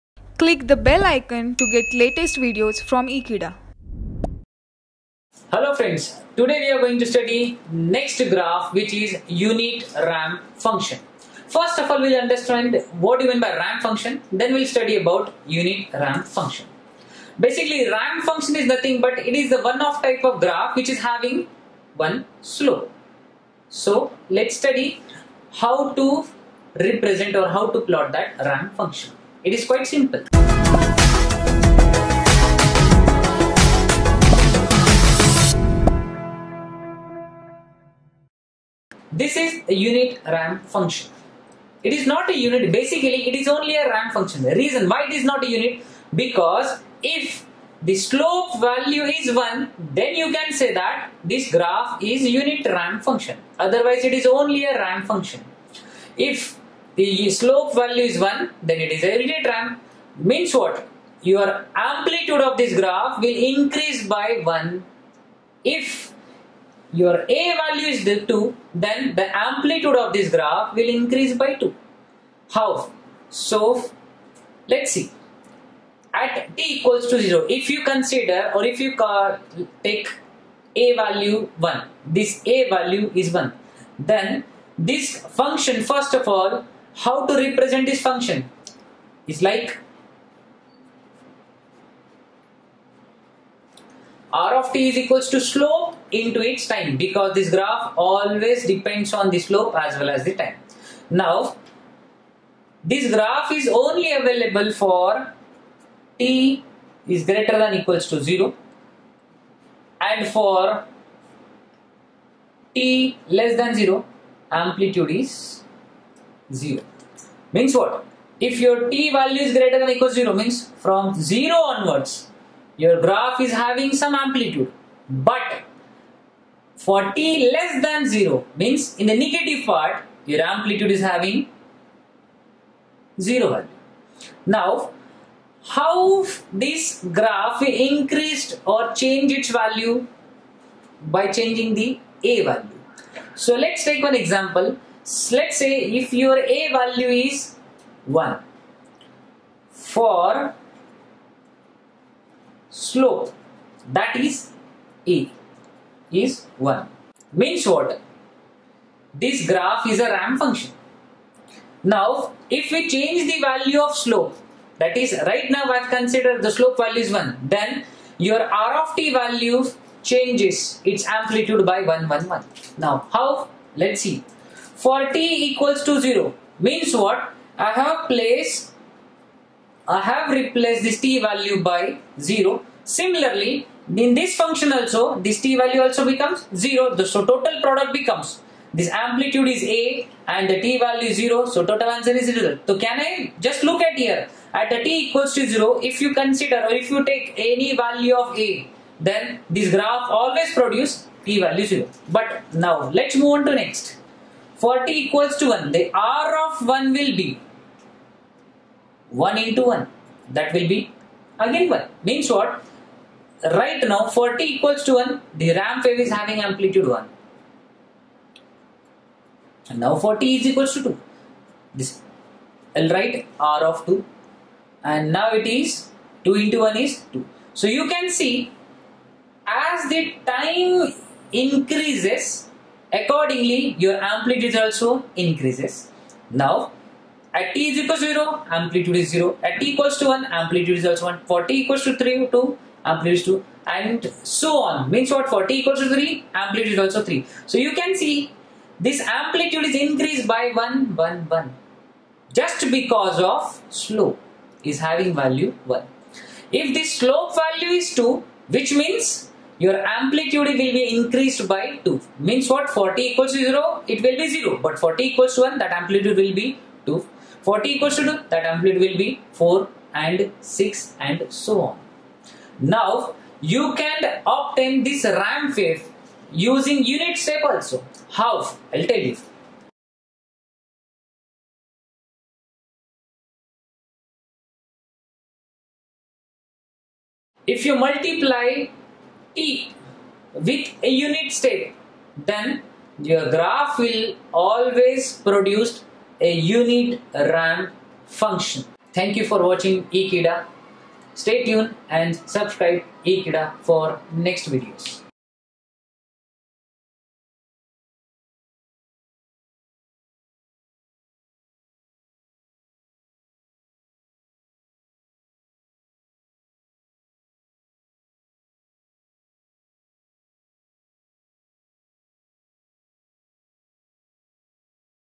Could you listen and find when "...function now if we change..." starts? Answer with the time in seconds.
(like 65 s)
160 s.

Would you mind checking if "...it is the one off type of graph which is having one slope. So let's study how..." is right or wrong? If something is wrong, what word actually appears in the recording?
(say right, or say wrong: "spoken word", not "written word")
right.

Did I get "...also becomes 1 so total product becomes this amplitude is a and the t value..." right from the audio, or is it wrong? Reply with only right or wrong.
wrong.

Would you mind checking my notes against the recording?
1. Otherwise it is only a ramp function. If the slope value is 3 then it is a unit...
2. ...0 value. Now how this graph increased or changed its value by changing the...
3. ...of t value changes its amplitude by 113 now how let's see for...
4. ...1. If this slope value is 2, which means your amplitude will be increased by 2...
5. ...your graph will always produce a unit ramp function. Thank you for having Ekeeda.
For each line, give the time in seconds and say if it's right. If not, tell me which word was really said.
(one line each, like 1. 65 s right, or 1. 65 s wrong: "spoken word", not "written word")
1. 53 s wrong: "1", not "3"
2. 133 s right
3. 168 s wrong: "111", not "113"
4. 255 s right
5. 293 s wrong: "watching", not "having".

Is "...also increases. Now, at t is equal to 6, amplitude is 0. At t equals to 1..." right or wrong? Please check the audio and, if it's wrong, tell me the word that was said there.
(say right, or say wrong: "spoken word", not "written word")
wrong: "0", not "6".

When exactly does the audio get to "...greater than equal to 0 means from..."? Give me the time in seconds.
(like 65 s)
119 s.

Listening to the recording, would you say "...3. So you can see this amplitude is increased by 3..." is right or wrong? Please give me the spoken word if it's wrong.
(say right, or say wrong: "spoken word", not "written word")
wrong: "1", not "3".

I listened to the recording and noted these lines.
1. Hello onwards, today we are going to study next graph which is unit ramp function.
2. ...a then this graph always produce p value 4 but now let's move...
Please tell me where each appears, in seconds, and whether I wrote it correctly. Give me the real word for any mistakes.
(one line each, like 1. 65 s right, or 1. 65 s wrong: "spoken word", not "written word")
1. 5 s wrong: "friends", not "onwards"
2. 198 s wrong: "0", not "4".